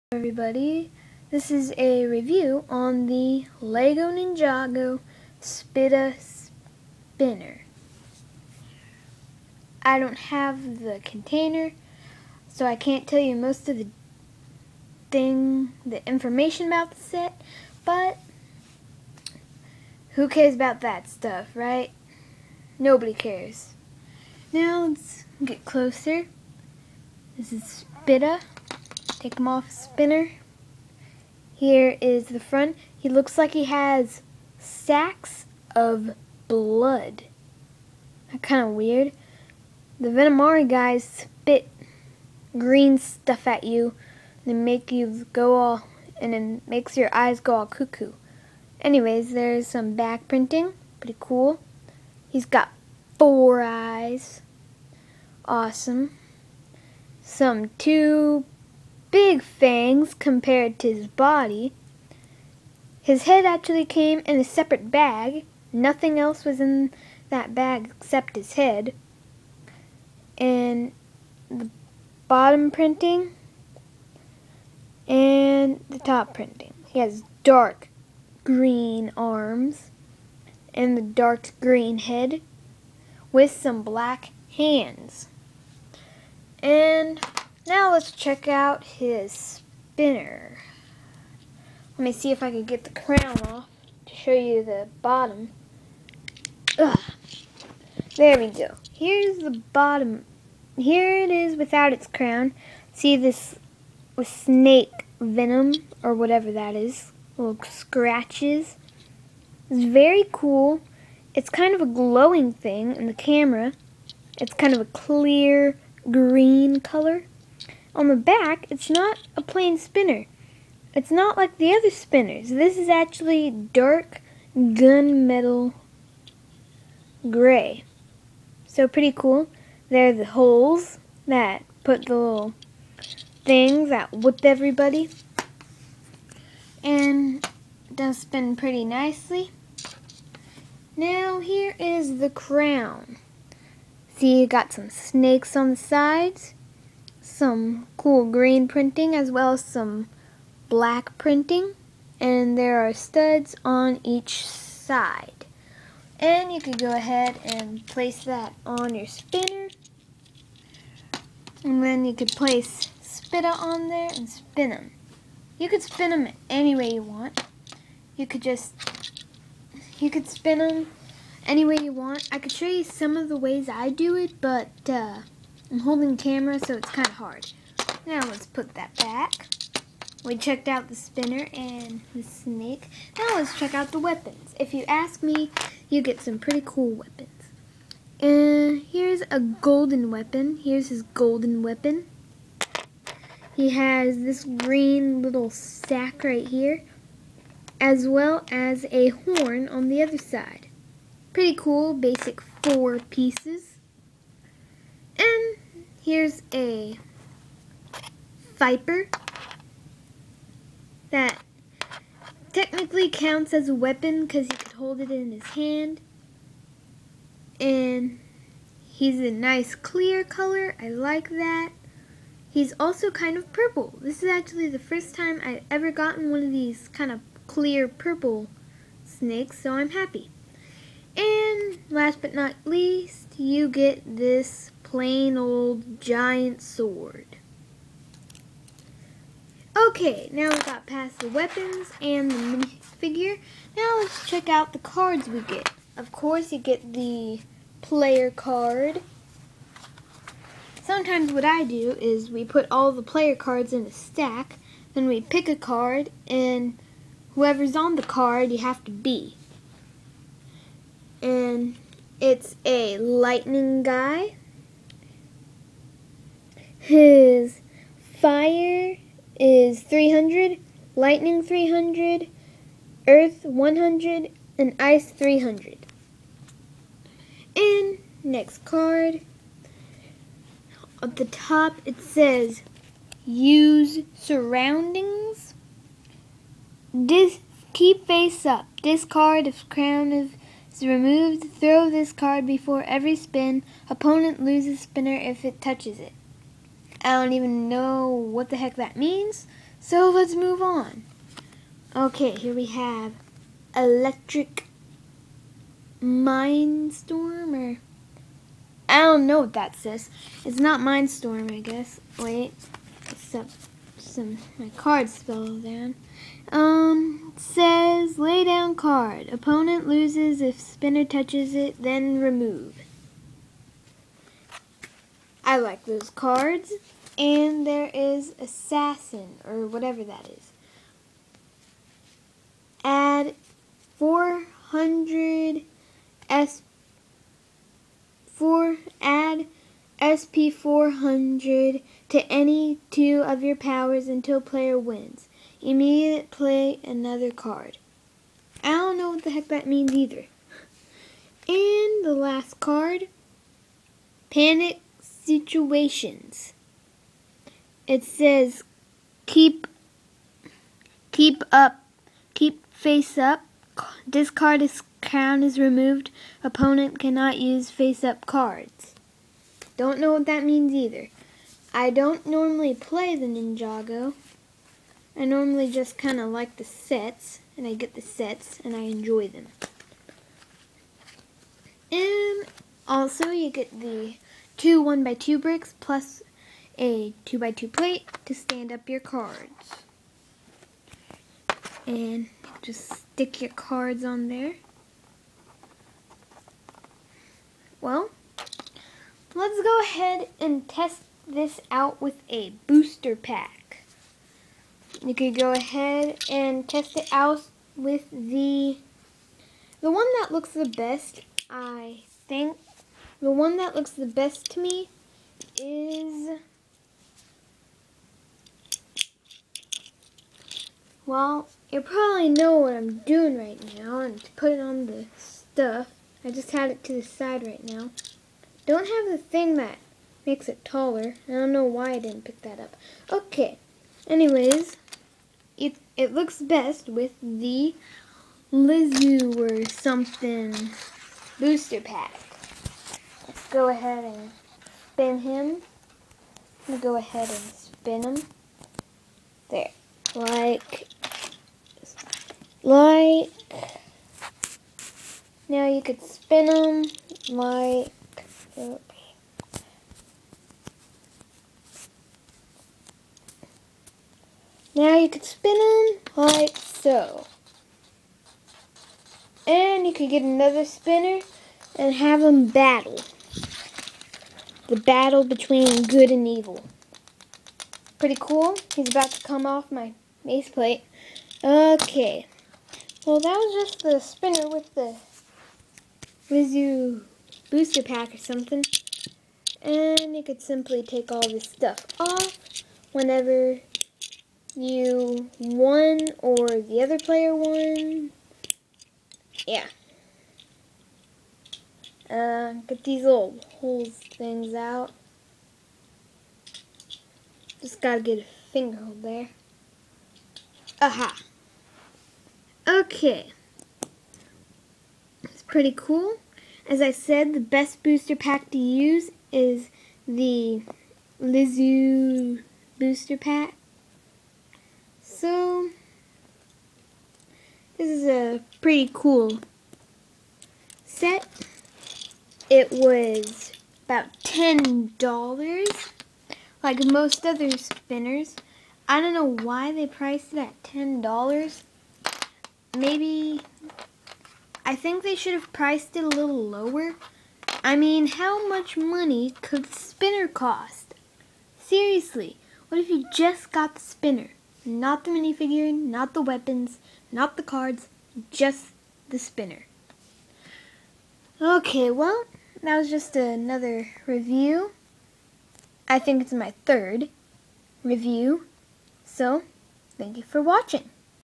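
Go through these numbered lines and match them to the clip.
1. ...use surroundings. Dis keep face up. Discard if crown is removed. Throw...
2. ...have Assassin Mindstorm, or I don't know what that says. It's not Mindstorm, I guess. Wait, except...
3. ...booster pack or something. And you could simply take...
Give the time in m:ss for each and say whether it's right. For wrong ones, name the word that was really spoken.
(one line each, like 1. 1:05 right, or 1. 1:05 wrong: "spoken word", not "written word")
1. 4:43 right
2. 5:02 wrong: "Electric", not "Assassin"
3. 8:07 right.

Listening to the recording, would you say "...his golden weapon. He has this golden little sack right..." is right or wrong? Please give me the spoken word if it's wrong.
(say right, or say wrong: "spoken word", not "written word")
wrong: "green", not "golden".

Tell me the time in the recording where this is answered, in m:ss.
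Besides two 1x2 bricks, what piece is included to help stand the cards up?
6:27.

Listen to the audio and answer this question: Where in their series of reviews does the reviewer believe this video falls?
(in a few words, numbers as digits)
third.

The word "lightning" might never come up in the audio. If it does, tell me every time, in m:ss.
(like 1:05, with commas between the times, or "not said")
4:22, 4:30.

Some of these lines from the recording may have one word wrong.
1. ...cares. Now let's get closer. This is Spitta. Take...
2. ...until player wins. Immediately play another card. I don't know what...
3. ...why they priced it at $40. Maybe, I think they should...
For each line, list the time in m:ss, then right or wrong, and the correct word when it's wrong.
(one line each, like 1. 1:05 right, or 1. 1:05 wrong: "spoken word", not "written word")
1. 0:23 right
2. 5:44 right
3. 8:59 wrong: "10", not "40".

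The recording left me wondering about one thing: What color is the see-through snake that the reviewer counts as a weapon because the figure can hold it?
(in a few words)
clear purple.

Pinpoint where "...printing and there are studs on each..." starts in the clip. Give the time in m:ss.
2:31.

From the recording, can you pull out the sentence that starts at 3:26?
Here's a Viper that technically counts as a weapon because he could hold it in his hand.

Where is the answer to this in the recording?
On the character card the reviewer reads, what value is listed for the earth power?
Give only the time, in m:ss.
4:33.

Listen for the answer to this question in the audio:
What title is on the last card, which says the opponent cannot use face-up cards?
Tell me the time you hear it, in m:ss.
5:54.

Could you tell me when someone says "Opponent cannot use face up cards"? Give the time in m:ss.
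6:06.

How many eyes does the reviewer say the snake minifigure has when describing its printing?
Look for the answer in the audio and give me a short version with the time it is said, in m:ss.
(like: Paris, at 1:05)
4, at 0:53.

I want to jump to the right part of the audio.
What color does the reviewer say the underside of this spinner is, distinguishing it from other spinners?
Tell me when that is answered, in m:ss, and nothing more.
2:03.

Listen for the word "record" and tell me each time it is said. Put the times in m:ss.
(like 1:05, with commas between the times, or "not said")
not said.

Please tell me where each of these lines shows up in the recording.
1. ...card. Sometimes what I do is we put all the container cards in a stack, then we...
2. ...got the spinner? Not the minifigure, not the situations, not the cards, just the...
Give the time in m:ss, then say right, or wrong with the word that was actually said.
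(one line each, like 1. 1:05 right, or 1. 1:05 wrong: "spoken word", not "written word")
1. 4:08 wrong: "player", not "container"
2. 9:13 wrong: "weapons", not "situations".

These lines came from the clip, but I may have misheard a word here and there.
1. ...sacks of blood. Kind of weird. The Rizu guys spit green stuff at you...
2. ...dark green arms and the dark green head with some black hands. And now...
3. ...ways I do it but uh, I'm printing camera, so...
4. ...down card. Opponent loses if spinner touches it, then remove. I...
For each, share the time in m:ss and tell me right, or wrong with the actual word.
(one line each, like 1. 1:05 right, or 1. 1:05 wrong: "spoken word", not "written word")
1. 0:34 wrong: "Venomari", not "Rizu"
2. 1:17 right
3. 2:53 wrong: "holding", not "printing"
4. 5:18 right.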